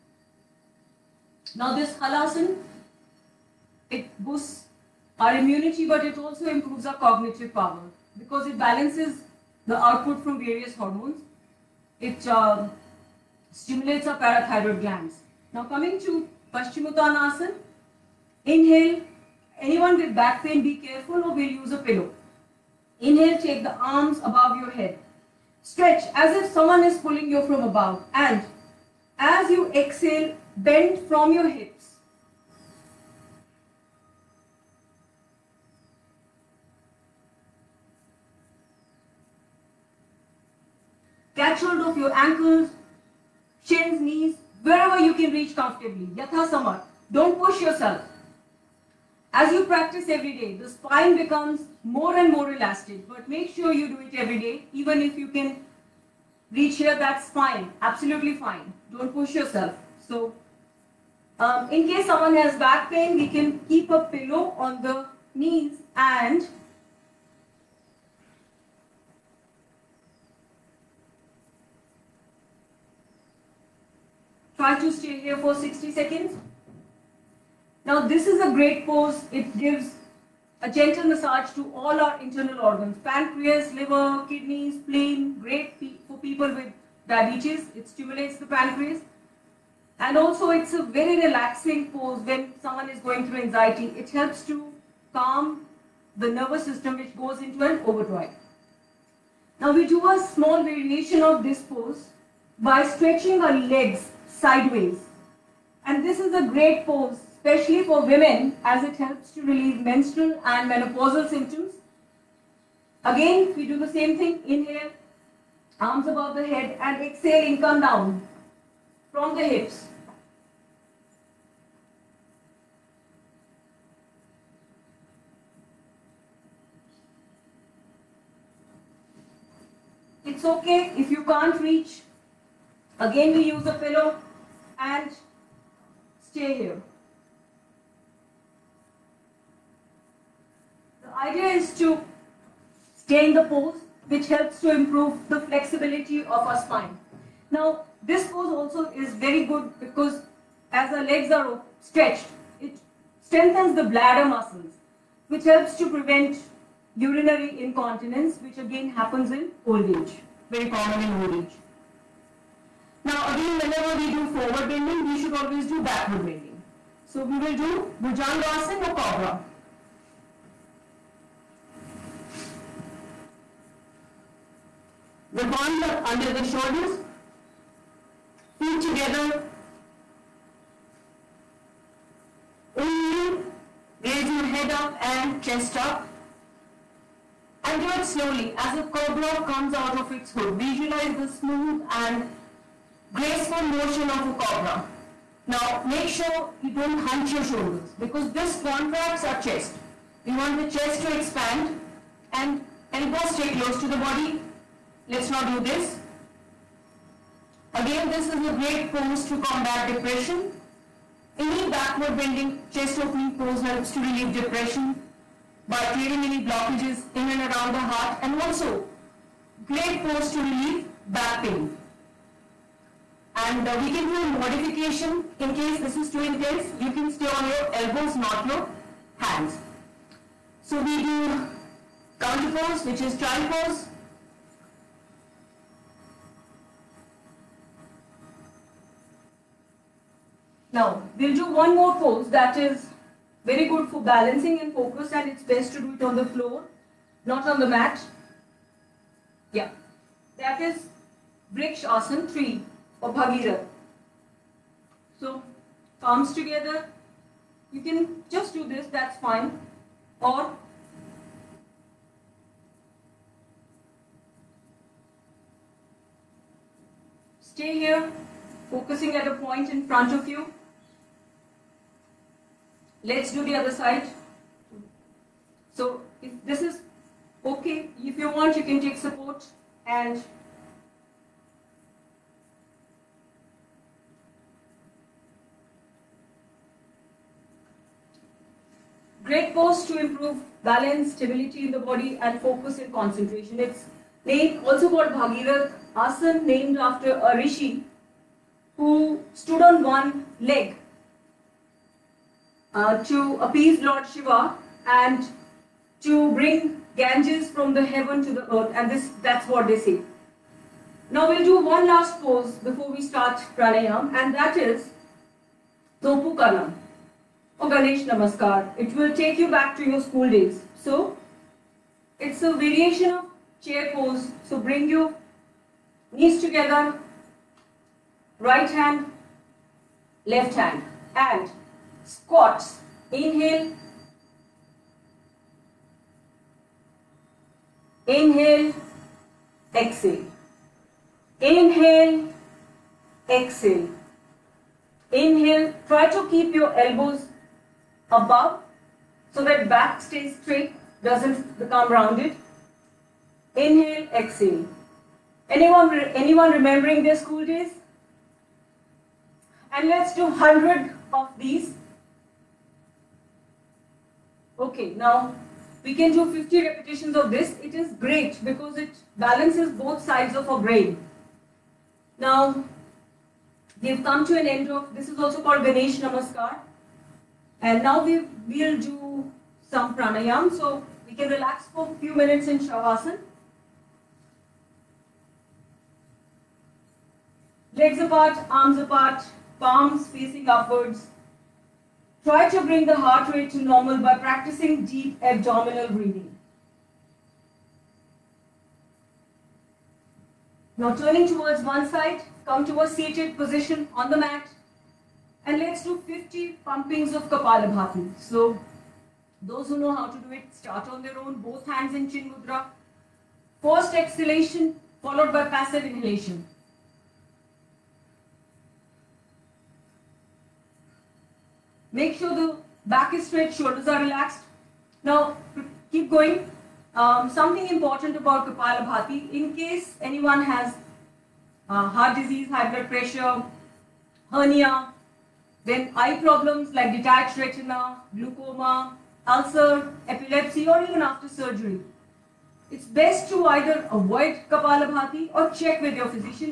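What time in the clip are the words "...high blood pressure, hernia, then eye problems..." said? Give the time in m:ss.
7:12.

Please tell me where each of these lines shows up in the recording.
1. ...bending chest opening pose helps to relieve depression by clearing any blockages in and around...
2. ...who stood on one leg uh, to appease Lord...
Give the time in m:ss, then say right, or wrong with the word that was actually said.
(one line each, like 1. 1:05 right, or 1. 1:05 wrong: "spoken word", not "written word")
1. 3:32 right
2. 4:58 right.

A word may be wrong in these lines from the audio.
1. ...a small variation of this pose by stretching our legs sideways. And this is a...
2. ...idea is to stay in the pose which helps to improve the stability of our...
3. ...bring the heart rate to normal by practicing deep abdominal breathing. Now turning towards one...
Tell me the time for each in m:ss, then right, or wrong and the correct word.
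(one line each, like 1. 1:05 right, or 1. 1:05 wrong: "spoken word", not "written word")
1. 1:40 right
2. 2:21 wrong: "flexibility", not "stability"
3. 6:32 right.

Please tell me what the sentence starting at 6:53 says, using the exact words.
First exhalation followed by passive inhalation.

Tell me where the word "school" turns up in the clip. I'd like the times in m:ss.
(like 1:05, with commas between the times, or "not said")
5:20, 5:57.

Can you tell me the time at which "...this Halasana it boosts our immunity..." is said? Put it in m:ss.
0:01.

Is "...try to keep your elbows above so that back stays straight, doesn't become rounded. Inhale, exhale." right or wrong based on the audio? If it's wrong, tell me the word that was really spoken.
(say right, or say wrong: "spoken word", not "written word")
right.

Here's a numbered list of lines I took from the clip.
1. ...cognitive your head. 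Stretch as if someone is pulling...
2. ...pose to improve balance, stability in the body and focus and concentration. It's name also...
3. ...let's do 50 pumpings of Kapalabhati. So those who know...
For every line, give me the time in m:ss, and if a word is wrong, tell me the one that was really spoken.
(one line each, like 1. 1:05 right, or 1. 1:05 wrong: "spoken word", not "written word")
1. 0:24 wrong: "above", not "cognitive"
2. 4:49 right
3. 6:45 right.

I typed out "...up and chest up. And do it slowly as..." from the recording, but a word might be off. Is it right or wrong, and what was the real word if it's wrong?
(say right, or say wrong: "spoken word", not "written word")
right.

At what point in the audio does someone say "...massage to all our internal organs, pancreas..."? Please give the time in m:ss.
1:21.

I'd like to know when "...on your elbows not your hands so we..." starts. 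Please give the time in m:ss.
3:47.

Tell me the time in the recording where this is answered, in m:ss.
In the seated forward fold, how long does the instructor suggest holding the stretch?
1:15.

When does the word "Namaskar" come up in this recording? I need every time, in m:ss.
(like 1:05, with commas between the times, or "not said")
5:18, 6:15.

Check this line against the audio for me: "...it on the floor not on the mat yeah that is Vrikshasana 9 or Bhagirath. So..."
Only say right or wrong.
wrong.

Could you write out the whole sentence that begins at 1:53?
Again, we do the same thing.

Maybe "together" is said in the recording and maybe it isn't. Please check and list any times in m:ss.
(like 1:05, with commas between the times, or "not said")
2:58, 4:16, 5:26.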